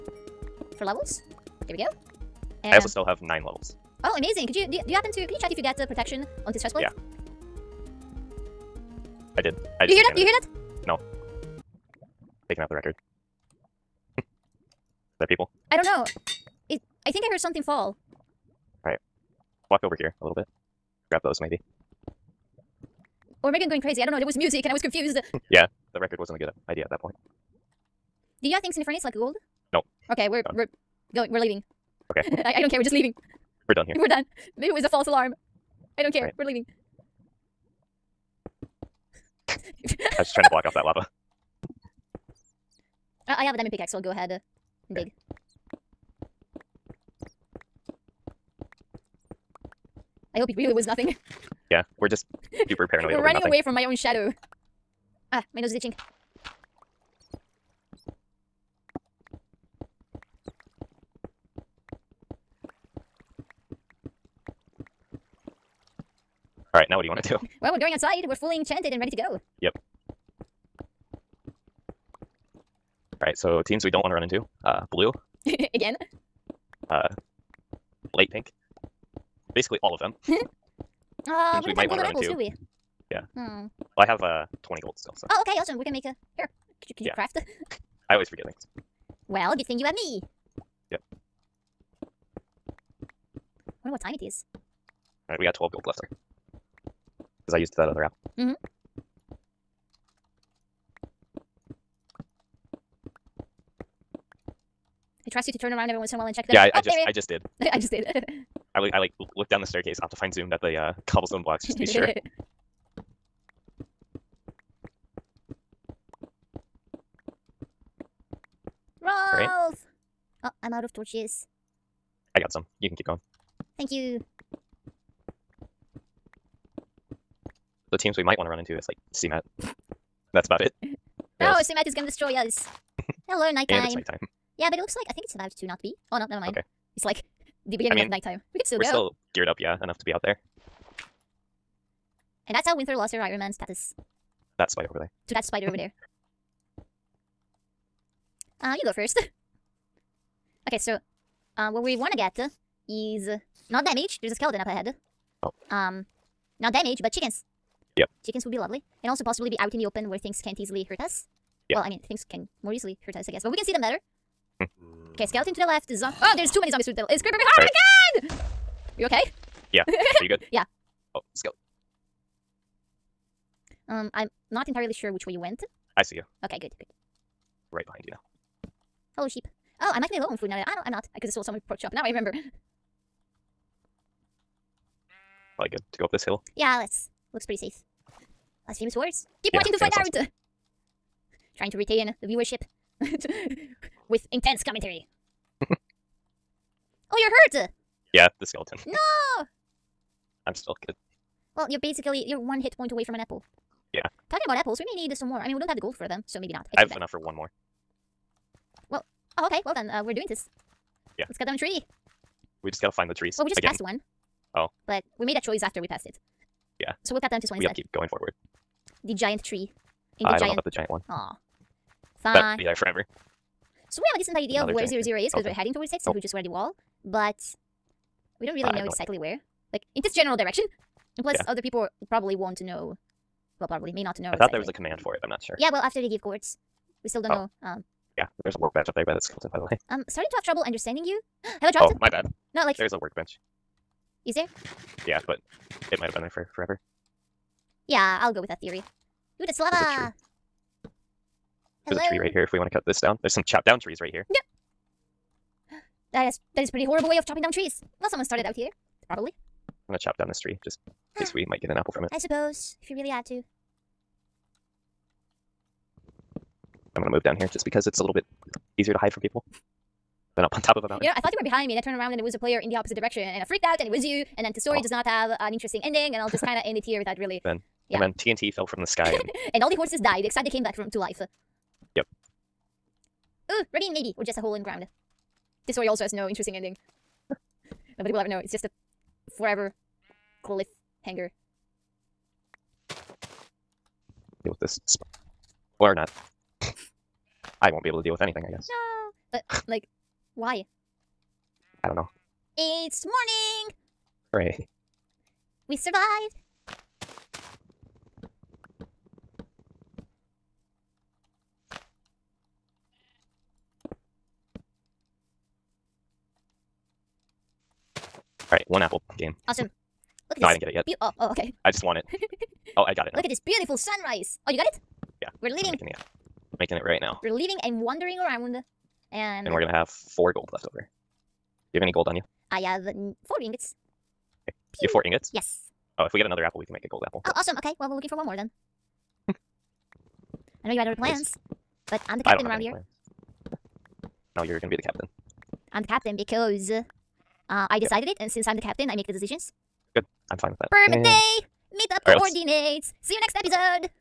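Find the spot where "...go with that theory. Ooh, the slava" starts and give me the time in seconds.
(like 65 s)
248 s.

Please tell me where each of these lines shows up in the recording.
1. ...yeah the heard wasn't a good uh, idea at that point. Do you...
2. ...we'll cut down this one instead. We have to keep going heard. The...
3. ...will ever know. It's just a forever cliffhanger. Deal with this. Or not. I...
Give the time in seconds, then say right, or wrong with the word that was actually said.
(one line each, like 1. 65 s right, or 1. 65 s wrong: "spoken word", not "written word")
1. 25 s wrong: "record", not "heard"
2. 217 s wrong: "forward", not "heard"
3. 288 s right.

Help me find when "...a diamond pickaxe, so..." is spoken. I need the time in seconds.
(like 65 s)
43 s.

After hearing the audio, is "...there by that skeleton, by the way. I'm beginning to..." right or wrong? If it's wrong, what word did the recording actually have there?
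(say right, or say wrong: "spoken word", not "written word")
wrong: "starting", not "beginning".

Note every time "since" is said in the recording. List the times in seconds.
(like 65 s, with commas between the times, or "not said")
226 s, 348 s.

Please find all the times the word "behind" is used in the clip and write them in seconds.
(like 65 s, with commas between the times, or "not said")
167 s, 177 s, 271 s.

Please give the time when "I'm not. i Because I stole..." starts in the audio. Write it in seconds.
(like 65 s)
180 s.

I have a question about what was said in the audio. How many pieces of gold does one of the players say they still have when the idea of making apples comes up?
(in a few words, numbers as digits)
20.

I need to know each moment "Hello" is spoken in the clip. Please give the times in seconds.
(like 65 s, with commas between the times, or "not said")
133 s, 179 s.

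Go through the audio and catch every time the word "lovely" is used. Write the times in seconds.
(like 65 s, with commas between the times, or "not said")
158 s.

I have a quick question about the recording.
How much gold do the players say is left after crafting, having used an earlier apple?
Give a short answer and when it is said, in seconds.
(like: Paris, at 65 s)
12, at 95 s.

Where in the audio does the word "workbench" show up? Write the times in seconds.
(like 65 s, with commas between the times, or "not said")
238 s, 242 s.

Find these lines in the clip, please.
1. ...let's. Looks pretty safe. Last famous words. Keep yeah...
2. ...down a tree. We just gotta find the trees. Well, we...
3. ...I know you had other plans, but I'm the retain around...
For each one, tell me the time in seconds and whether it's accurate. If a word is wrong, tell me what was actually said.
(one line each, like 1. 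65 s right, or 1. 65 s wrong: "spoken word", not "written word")
1. 186 s right
2. 211 s right
3. 340 s wrong: "captain", not "retain".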